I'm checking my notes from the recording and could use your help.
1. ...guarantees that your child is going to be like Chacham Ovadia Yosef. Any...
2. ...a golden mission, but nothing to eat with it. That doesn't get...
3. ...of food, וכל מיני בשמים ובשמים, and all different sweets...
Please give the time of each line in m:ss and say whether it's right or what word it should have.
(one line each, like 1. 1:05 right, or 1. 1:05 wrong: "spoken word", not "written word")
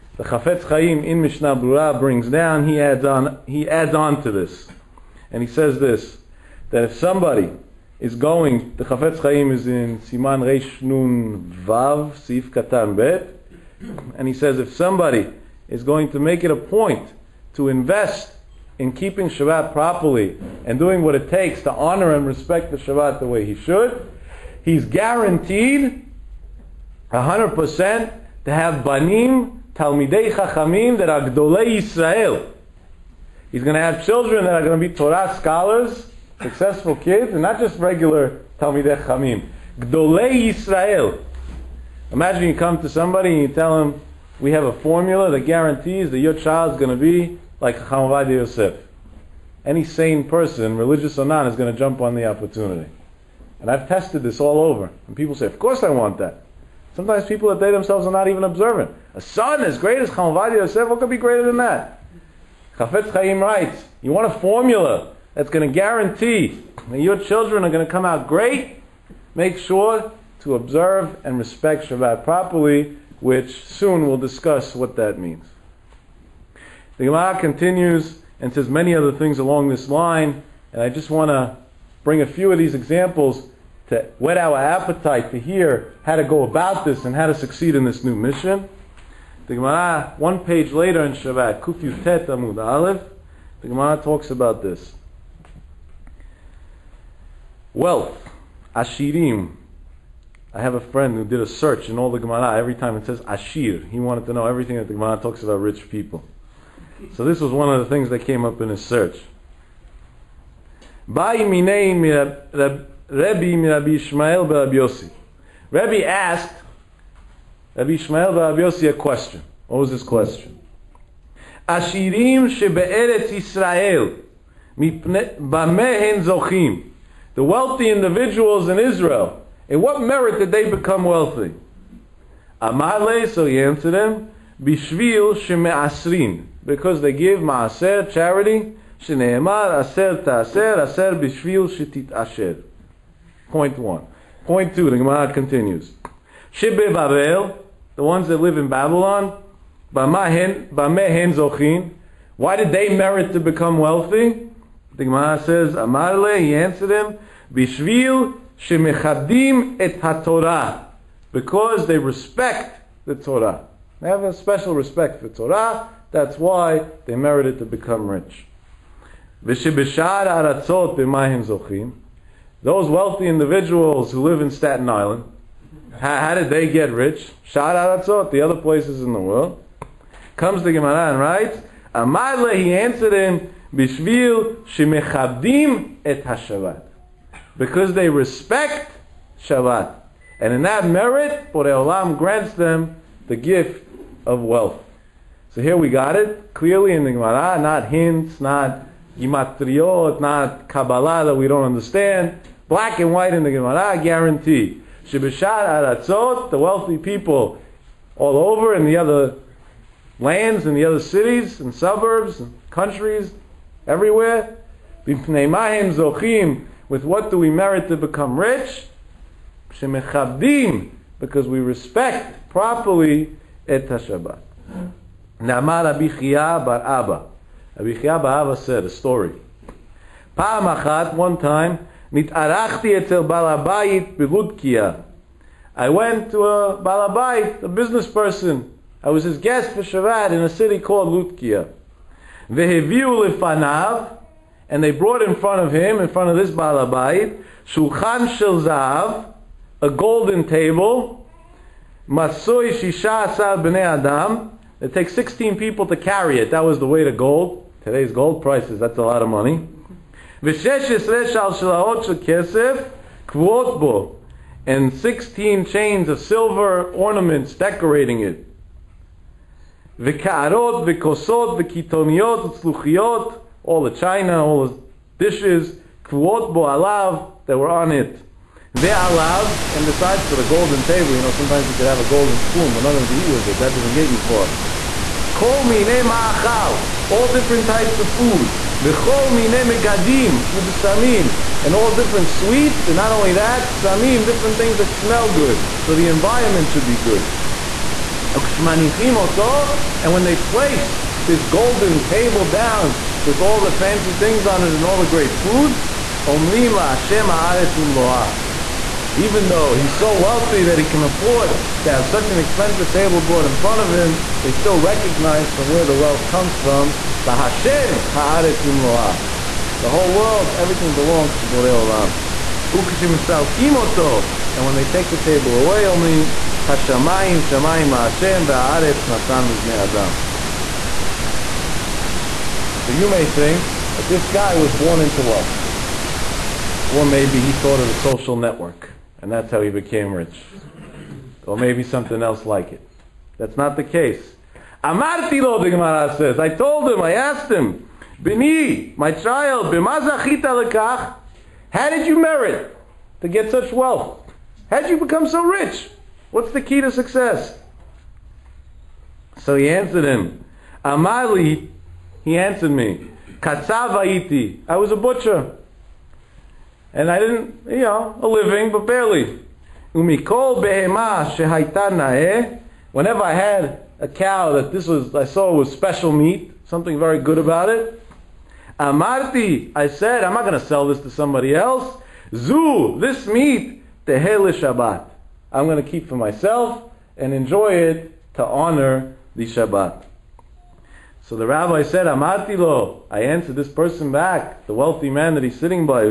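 1. 0:45 right
2. 4:41 wrong: "spoon", not "mission"
3. 4:47 wrong: "מגדים", not "בשמים".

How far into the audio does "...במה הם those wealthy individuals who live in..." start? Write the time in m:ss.
2:50.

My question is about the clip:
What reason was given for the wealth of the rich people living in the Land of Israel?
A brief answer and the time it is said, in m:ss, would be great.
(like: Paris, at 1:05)
They give ma'aser, at 2:15.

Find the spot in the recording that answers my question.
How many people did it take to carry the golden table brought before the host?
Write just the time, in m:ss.
4:12.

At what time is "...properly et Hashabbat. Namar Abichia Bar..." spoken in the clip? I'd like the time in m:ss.
3:42.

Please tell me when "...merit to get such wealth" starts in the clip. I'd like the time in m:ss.
5:52.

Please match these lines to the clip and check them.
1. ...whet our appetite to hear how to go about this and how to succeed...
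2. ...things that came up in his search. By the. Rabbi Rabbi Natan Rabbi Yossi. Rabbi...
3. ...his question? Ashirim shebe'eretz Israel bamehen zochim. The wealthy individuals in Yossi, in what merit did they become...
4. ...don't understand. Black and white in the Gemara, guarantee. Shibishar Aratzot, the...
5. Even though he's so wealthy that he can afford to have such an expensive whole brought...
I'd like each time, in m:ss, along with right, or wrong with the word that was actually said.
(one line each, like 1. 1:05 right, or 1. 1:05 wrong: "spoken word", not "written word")
1. 1:24 right
2. 1:47 wrong: "Ishmael", not "Natan"
3. 1:59 wrong: "Israel", not "Yossi"
4. 3:21 right
5. 5:09 wrong: "table", not "whole".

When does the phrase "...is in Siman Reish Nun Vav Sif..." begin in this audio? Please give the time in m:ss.
0:09.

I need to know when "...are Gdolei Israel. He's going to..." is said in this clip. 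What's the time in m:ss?
0:31.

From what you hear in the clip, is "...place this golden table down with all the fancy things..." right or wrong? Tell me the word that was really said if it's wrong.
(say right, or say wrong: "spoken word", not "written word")
right.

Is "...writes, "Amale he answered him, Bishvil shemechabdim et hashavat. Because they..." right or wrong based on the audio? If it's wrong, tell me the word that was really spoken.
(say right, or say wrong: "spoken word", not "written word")
right.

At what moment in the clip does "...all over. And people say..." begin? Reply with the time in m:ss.
0:54.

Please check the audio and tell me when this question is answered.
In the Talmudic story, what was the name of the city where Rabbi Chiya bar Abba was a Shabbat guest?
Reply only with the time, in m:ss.
4:01.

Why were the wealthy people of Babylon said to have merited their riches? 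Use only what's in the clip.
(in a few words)
They respect the Torah.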